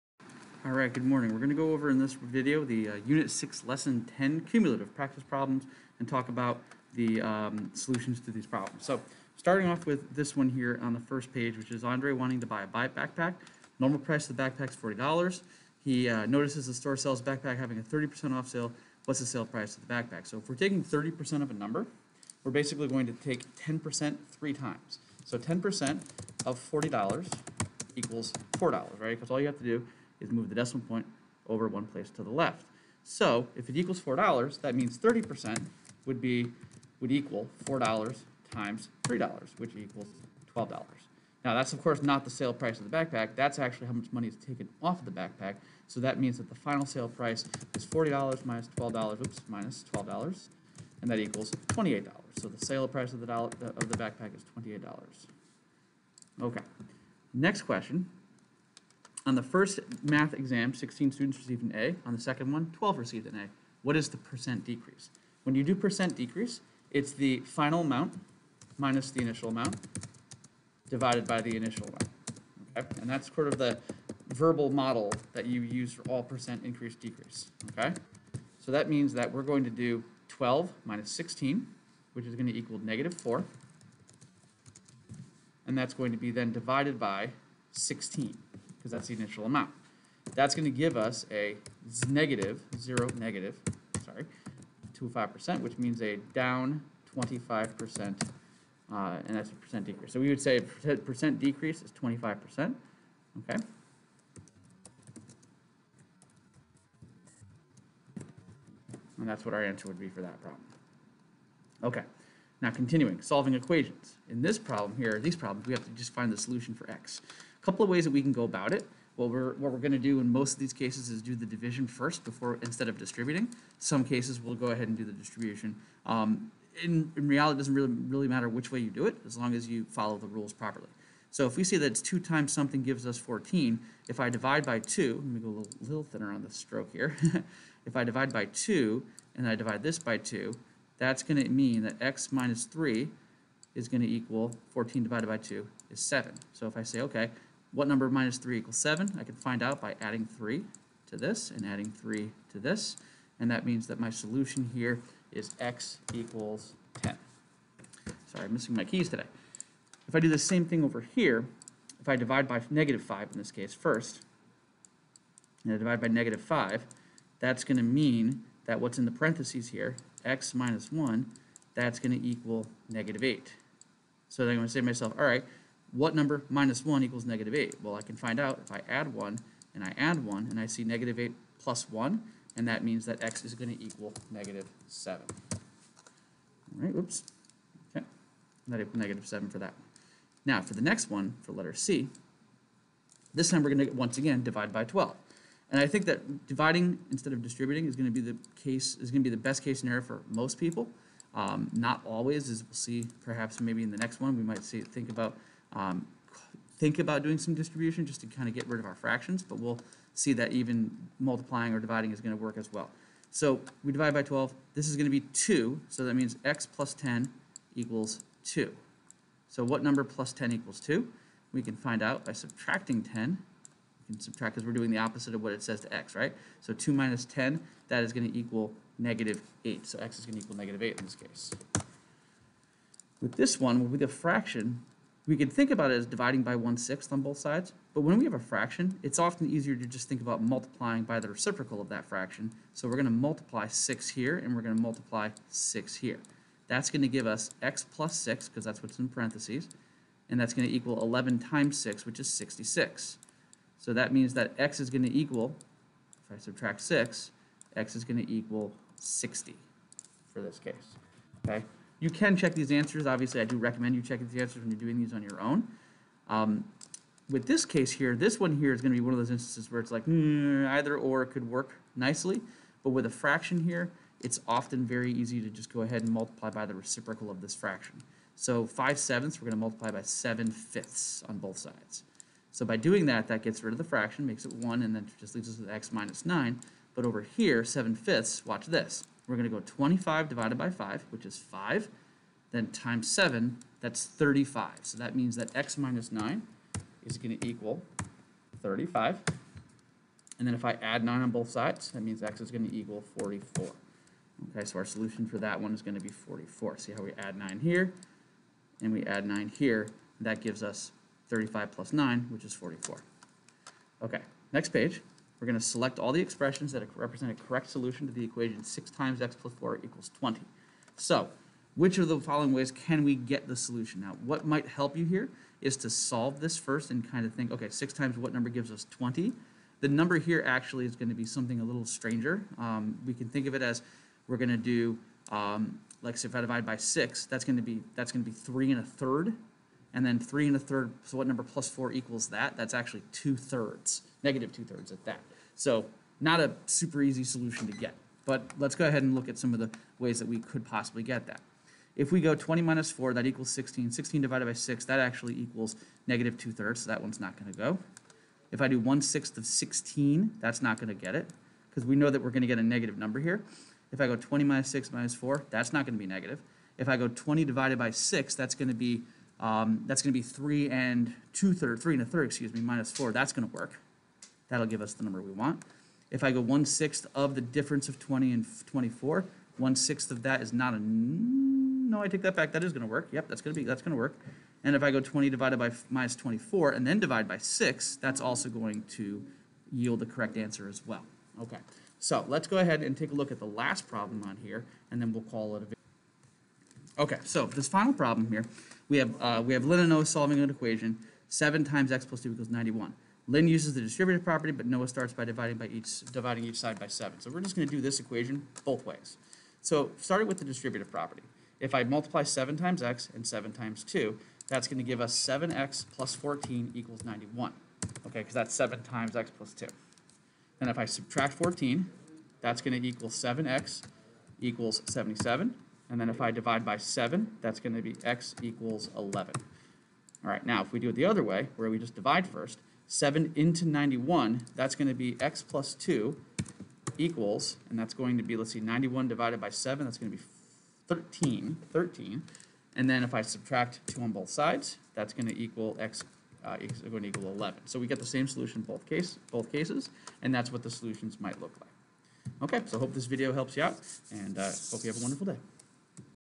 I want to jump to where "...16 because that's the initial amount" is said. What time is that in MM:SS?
01:27.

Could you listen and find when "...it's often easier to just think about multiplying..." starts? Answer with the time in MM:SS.
03:59.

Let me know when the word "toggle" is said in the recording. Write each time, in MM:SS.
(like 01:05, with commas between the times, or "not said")
not said.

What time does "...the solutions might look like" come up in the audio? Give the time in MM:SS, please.
07:30.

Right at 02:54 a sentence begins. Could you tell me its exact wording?
So then I'm going to say to myself, all right, what number minus 1 equals negative 8?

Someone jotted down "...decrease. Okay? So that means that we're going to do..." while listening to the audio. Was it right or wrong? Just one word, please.
right.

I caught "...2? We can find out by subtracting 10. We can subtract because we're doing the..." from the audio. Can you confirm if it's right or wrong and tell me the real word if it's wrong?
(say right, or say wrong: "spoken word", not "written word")
right.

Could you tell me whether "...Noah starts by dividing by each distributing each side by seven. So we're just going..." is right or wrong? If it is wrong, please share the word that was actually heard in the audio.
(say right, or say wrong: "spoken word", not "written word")
wrong: "dividing", not "distributing".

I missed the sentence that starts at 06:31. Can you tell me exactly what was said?
Okay, so let's go ahead and take a look at the last problem on here, and then we'll call it a video.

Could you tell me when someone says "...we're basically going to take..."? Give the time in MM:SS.
00:22.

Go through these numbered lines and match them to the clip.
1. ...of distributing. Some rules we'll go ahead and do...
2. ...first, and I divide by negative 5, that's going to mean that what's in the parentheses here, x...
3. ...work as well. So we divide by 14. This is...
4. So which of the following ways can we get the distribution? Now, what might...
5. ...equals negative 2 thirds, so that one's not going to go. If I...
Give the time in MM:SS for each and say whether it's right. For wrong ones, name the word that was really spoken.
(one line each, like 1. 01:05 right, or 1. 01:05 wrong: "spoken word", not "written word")
1. 02:02 wrong: "cases", not "rules"
2. 02:43 right
3. 03:32 wrong: "12", not "14"
4. 05:20 wrong: "solution", not "distribution"
5. 05:55 right.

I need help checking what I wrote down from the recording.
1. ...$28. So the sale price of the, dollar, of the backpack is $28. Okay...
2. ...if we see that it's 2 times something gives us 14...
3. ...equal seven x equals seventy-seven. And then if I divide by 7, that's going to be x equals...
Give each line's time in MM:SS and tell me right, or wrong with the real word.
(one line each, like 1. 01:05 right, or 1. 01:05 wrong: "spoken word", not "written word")
1. 00:51 right
2. 02:11 right
3. 07:02 right.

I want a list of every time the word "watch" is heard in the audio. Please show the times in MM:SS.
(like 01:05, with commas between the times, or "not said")
04:48.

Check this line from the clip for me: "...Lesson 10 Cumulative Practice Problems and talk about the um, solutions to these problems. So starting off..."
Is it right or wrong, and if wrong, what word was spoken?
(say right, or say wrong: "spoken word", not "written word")
right.